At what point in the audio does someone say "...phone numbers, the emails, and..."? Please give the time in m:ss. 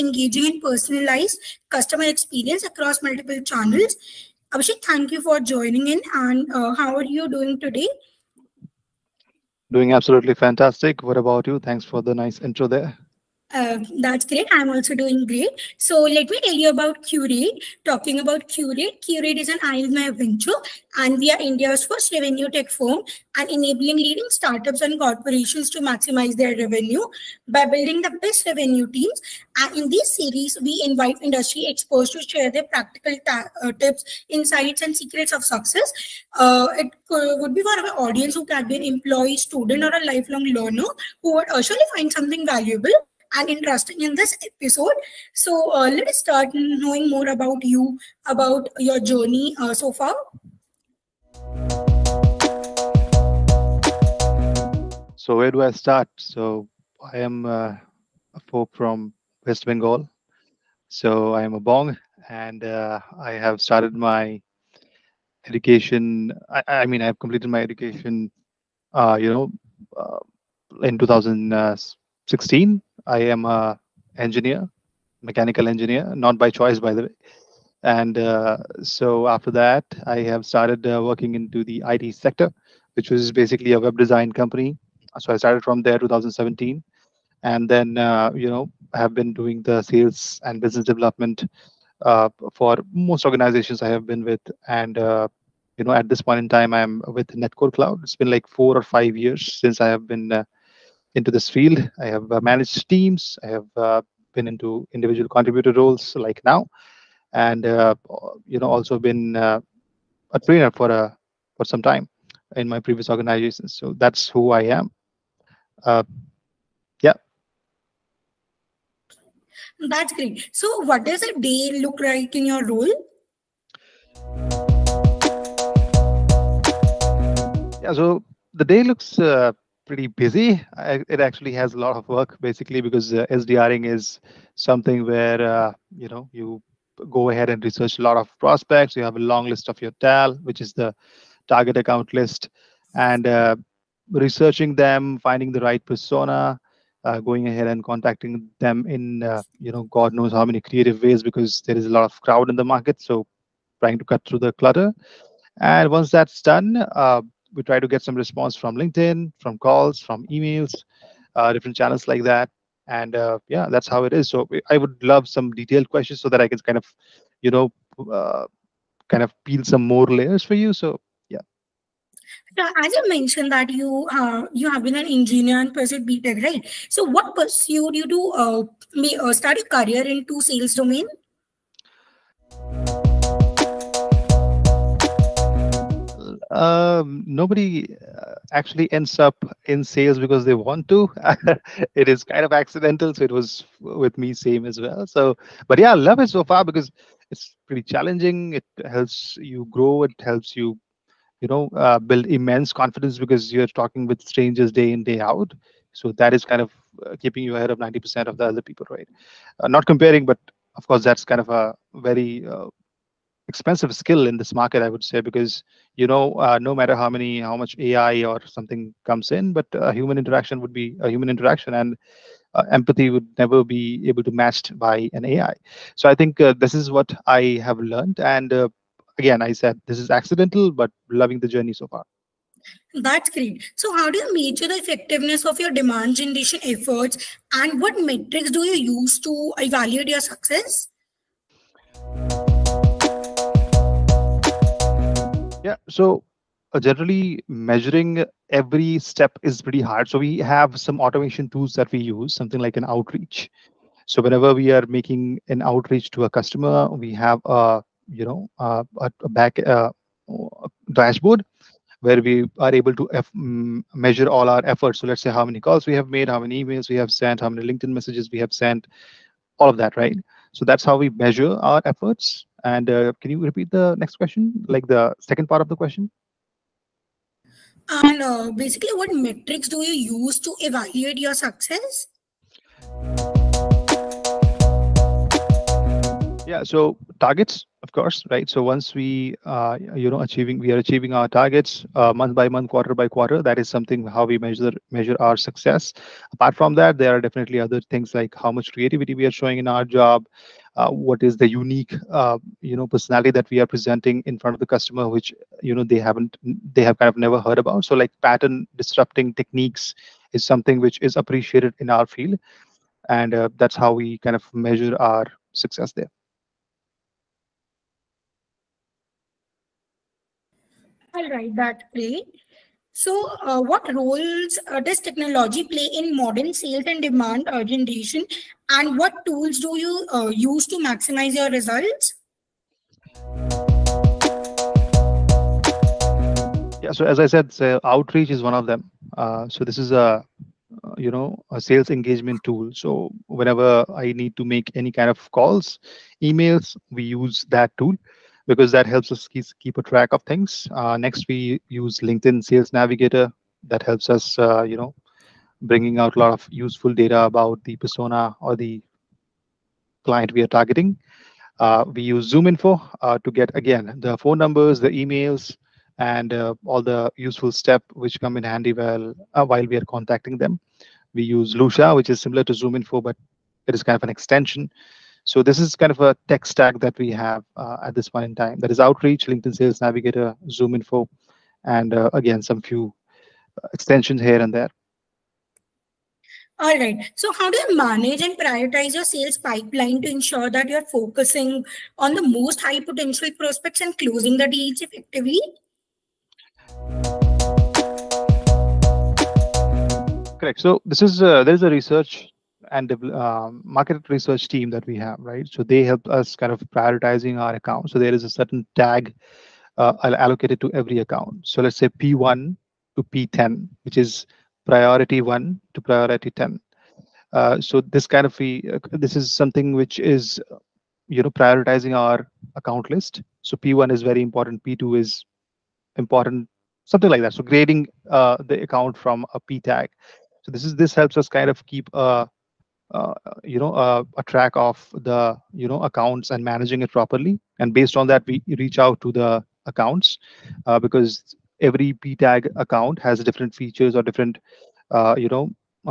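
6:04.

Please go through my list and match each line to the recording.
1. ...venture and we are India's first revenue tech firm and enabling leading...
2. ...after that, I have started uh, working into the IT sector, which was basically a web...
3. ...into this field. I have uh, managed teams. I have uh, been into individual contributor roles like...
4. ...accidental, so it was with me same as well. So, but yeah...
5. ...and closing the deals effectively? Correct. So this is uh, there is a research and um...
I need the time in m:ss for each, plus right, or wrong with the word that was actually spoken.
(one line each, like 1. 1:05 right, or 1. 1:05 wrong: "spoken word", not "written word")
1. 0:20 right
2. 1:19 right
3. 1:41 right
4. 3:12 right
5. 6:33 right.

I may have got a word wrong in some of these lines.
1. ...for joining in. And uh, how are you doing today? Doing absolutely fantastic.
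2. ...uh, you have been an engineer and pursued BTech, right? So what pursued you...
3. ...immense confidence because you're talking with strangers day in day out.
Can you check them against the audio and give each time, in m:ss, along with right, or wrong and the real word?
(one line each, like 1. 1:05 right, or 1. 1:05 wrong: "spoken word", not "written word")
1. 0:05 right
2. 2:54 right
3. 3:22 right.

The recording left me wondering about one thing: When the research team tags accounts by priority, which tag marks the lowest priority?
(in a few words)
P10.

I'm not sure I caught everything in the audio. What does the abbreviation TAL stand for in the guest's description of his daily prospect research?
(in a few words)
Target account list.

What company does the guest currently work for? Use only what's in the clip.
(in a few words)
Netcore Cloud.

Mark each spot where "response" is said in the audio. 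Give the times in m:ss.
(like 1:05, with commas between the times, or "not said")
2:38.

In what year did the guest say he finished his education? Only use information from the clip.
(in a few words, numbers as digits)
2016.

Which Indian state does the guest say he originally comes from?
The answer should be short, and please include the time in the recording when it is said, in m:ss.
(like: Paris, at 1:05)
West Bengal, at 0:59.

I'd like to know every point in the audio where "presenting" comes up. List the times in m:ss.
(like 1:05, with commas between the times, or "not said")
5:03.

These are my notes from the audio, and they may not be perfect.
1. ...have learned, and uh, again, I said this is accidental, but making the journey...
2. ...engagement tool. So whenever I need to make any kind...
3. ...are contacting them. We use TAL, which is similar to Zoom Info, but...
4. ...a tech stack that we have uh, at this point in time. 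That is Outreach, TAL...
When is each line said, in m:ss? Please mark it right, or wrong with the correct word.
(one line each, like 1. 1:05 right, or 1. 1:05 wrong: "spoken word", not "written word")
1. 3:47 wrong: "loving", not "making"
2. 5:41 right
3. 6:09 wrong: "Lusha", not "TAL"
4. 6:16 wrong: "LinkedIn", not "TAL".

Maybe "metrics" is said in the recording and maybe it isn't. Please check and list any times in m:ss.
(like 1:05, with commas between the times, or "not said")
3:58, 4:39.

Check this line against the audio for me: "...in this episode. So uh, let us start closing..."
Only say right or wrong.
wrong.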